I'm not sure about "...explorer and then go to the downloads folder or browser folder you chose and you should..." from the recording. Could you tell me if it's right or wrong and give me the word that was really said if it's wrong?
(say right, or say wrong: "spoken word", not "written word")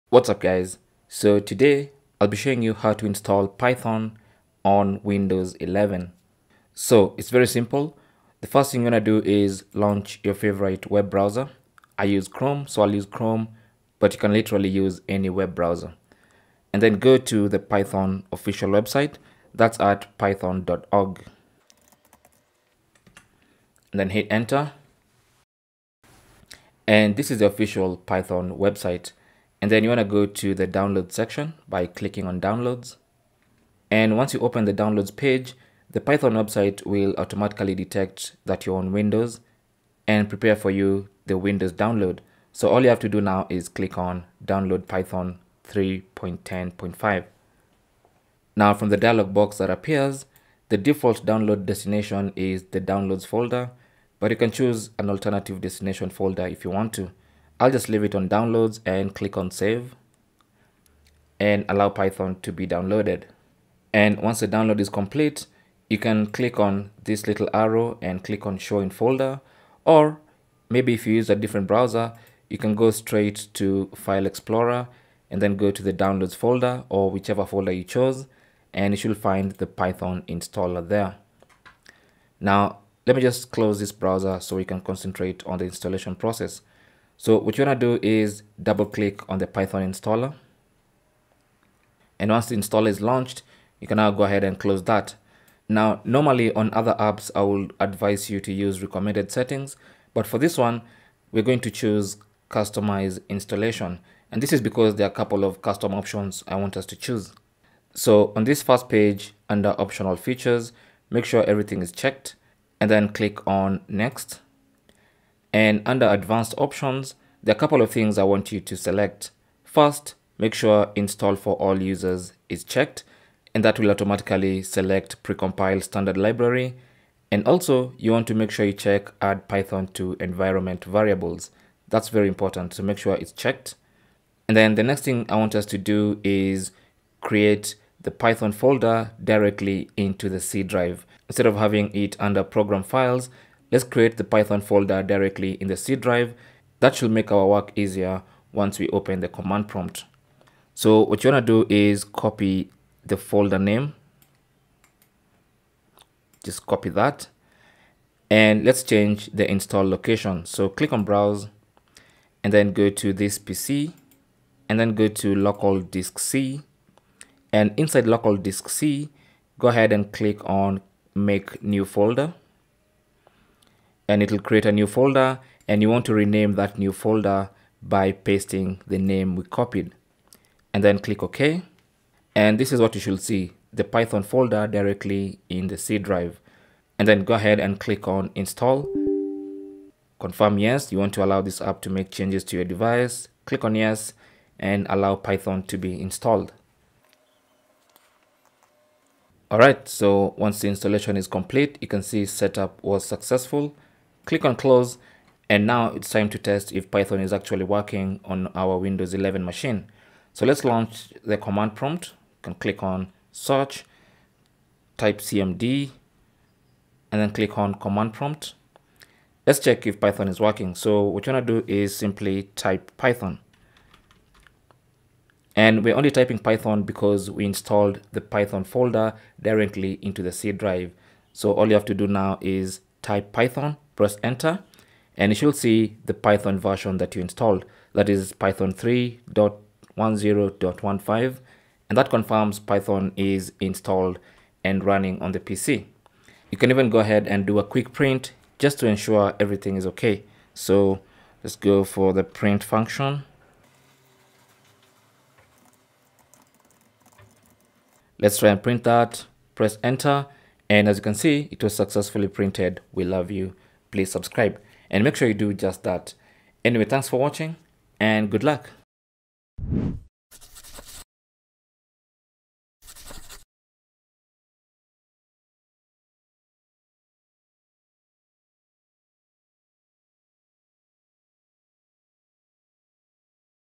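wrong: "whichever", not "browser".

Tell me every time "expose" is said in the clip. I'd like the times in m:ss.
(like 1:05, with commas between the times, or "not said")
not said.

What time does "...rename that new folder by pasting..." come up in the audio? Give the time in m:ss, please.
2:56.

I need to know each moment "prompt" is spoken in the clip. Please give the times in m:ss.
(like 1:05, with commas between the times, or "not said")
2:29, 3:31, 3:38.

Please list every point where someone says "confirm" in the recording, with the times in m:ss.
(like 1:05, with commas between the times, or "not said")
3:10, 4:02.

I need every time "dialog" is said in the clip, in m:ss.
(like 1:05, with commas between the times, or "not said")
0:48.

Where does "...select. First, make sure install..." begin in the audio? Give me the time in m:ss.
1:58.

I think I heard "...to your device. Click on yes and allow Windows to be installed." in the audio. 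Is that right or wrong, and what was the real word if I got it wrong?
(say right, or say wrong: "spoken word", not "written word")
wrong: "Python", not "Windows".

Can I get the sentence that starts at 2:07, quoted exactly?
And also you want to make sure you check add Python to environment variables.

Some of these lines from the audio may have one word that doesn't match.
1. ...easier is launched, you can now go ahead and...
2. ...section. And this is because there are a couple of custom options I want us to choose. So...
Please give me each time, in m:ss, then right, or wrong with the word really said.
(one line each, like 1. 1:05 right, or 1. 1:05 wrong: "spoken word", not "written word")
1. 1:32 wrong: "installer", not "easier"
2. 1:43 wrong: "installation", not "section".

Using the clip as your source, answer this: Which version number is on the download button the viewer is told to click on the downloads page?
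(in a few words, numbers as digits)
3.10.5.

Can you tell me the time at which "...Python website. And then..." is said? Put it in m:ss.
0:27.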